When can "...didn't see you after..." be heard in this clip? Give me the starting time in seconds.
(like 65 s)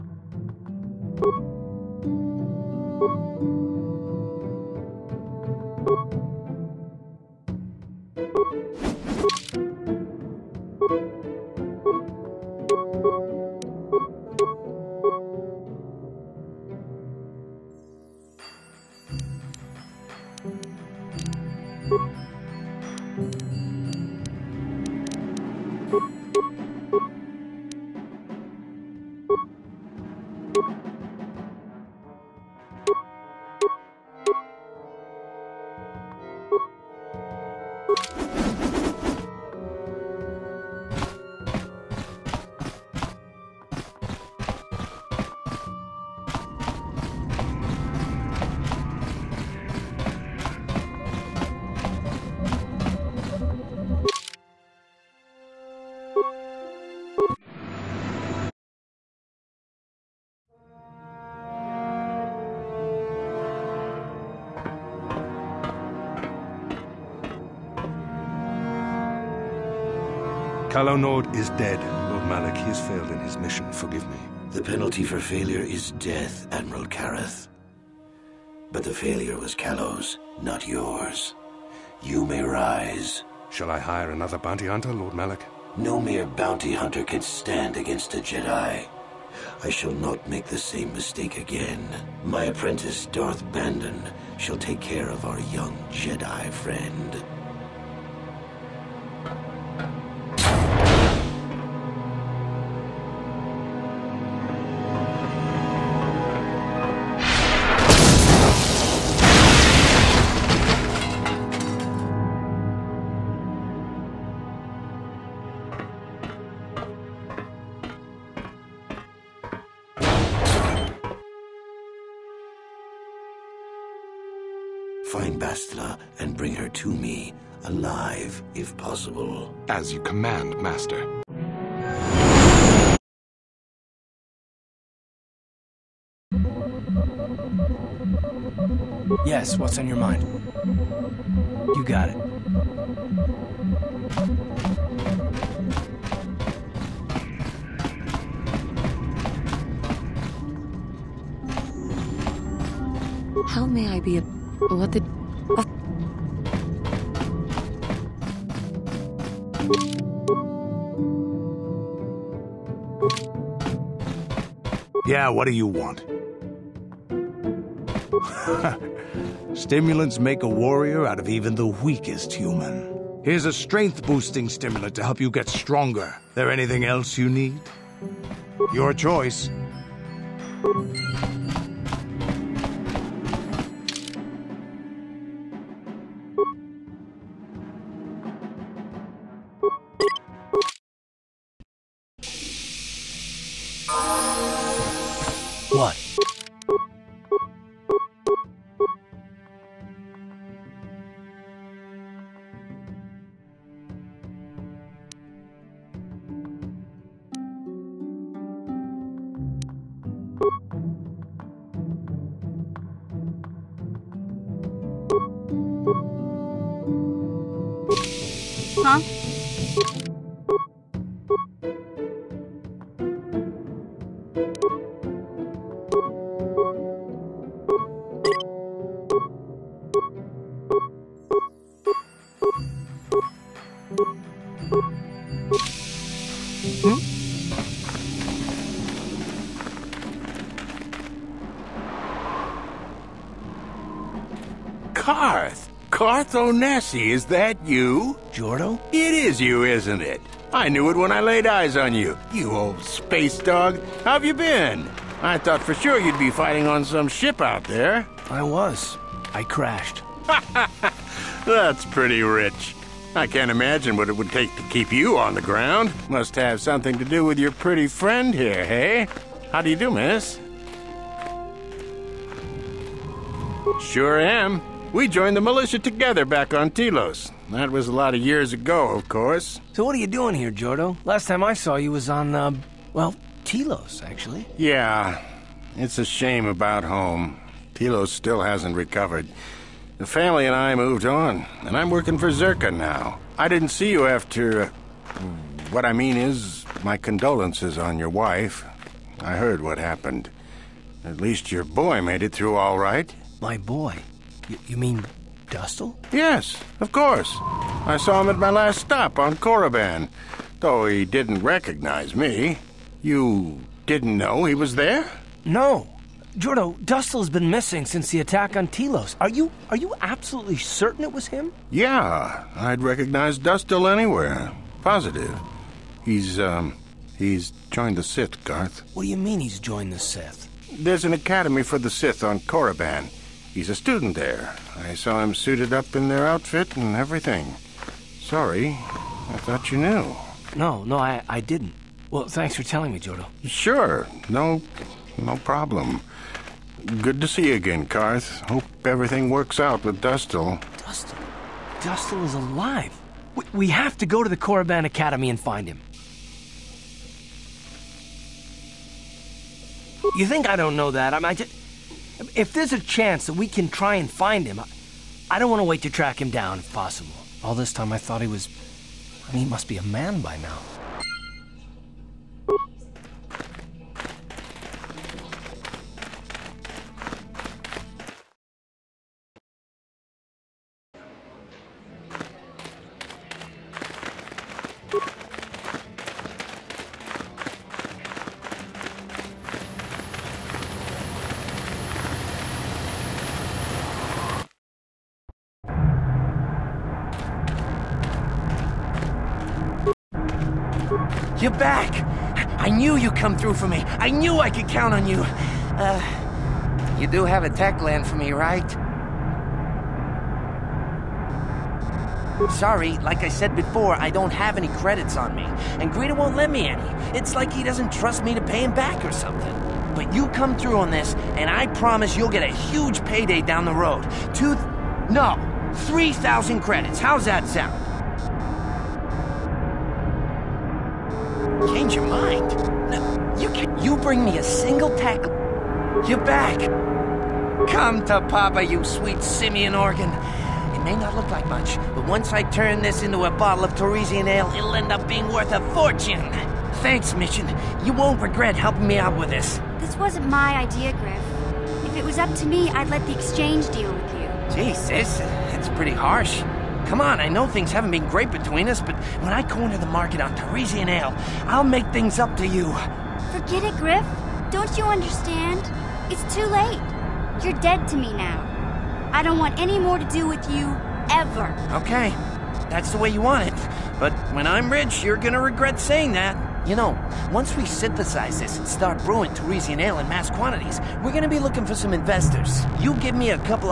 293 s.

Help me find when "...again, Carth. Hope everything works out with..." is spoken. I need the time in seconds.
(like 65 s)
347 s.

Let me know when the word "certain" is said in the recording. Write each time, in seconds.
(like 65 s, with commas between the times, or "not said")
320 s.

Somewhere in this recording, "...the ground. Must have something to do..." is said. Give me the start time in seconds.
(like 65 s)
265 s.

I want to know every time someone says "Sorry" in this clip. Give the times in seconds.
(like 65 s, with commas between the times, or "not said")
338 s, 412 s.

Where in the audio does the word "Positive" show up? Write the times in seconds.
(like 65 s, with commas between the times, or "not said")
324 s.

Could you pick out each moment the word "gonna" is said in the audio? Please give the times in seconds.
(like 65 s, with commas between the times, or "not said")
475 s, 481 s.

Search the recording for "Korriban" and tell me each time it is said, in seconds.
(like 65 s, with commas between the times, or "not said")
309 s, 332 s, 354 s.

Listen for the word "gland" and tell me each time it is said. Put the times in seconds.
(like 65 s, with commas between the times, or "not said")
407 s.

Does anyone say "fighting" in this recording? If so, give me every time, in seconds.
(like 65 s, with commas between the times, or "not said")
256 s.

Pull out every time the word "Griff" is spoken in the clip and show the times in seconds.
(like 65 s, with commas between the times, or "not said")
450 s, 463 s.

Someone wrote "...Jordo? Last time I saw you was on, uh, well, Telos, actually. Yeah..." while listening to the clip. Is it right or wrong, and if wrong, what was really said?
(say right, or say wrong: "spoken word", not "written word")
right.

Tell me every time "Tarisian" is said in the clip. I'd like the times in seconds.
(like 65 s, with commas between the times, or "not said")
443 s, 460 s, 479 s.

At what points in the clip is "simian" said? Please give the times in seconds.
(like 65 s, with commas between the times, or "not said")
439 s.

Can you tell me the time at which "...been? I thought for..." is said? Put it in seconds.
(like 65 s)
254 s.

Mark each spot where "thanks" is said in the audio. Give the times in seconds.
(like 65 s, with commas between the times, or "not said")
342 s, 446 s.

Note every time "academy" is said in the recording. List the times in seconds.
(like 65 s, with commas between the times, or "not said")
331 s, 354 s.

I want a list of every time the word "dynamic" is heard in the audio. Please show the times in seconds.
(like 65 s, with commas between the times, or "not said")
not said.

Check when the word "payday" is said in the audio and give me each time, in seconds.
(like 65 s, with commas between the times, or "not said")
423 s.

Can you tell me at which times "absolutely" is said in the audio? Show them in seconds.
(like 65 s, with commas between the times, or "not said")
320 s.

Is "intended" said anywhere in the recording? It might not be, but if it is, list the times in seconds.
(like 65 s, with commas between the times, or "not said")
not said.